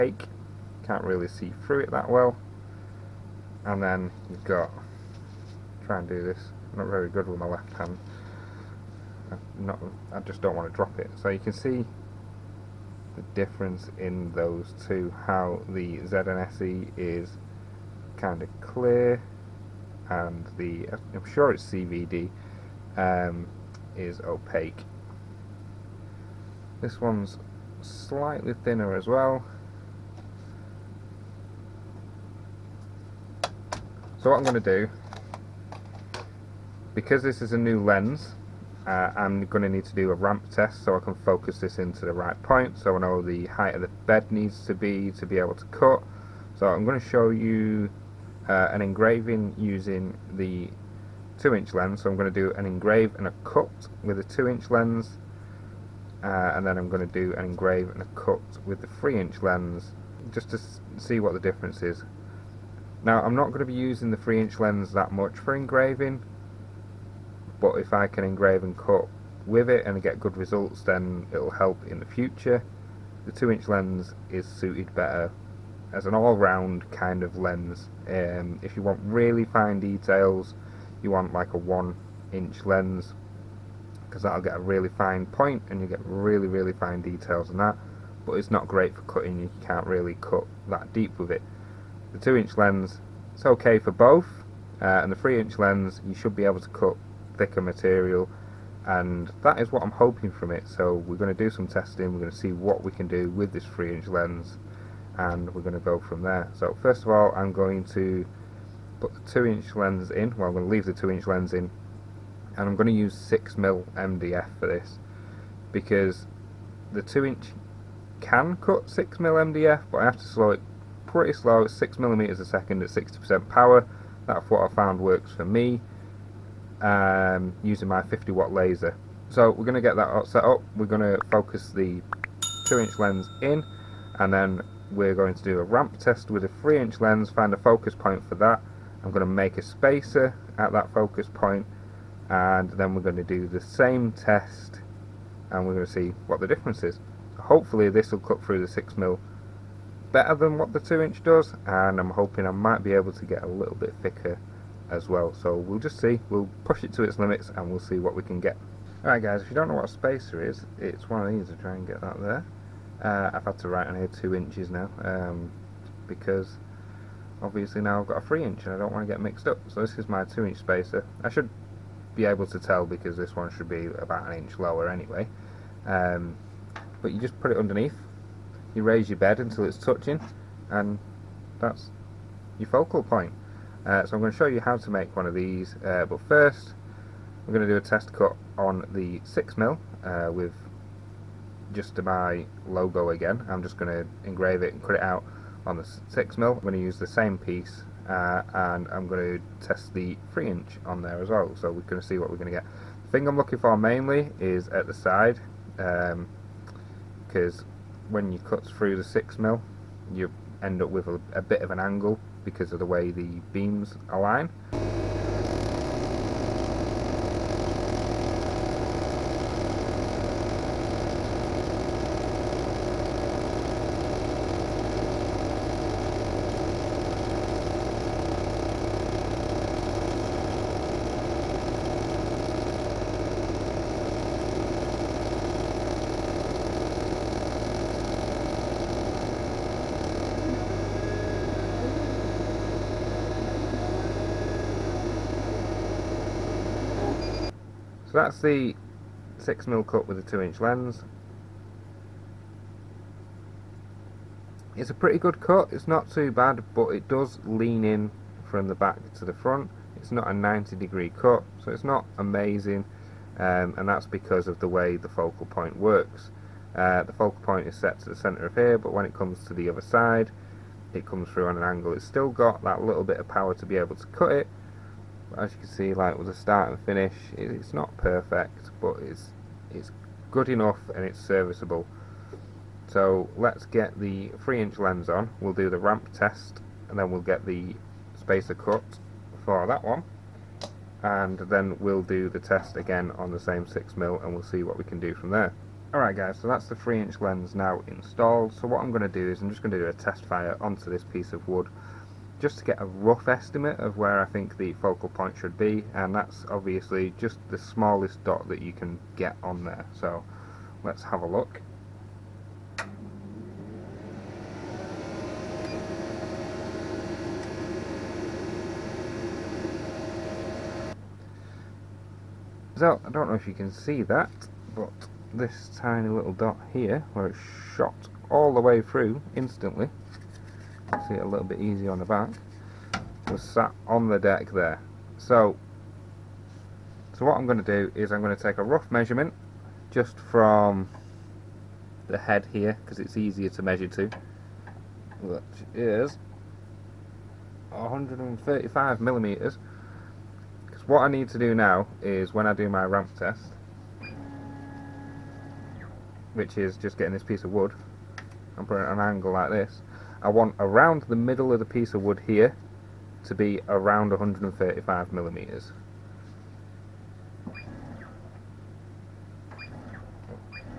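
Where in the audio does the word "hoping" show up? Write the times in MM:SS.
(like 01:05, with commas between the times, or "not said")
01:39, 02:32.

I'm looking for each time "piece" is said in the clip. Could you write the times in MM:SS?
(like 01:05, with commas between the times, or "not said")
03:17, 05:01, 05:57, 06:01.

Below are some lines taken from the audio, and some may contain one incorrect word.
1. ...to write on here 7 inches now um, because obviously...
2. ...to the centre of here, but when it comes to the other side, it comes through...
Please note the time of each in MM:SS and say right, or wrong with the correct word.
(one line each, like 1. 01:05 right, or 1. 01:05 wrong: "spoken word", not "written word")
1. 02:43 wrong: "2", not "7"
2. 04:27 right.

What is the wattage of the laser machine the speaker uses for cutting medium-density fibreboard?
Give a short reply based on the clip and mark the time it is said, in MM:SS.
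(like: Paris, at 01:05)
50 watt, at 02:08.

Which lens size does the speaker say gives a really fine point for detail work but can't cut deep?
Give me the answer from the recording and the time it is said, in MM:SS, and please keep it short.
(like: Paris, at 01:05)
1 inch, at 01:21.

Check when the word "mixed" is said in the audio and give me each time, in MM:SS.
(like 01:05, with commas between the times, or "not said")
02:49.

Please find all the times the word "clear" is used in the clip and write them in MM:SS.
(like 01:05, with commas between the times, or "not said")
00:18.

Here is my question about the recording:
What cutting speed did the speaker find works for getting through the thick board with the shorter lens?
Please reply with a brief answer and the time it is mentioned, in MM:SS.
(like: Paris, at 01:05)
6mm a second, at 02:01.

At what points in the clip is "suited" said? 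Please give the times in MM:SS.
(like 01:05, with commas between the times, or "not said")
01:14.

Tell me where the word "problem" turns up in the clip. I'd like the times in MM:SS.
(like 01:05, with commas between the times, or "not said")
not said.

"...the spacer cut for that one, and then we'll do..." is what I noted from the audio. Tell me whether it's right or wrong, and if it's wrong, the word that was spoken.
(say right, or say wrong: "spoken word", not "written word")
right.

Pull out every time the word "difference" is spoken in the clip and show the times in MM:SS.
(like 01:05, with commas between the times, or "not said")
00:13, 01:01, 02:26.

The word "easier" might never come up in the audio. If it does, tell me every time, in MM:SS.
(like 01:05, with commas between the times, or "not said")
05:31, 05:43.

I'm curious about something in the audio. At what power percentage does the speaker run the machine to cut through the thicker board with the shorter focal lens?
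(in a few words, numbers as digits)
60%.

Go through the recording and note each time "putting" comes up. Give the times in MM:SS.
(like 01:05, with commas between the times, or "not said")
05:58.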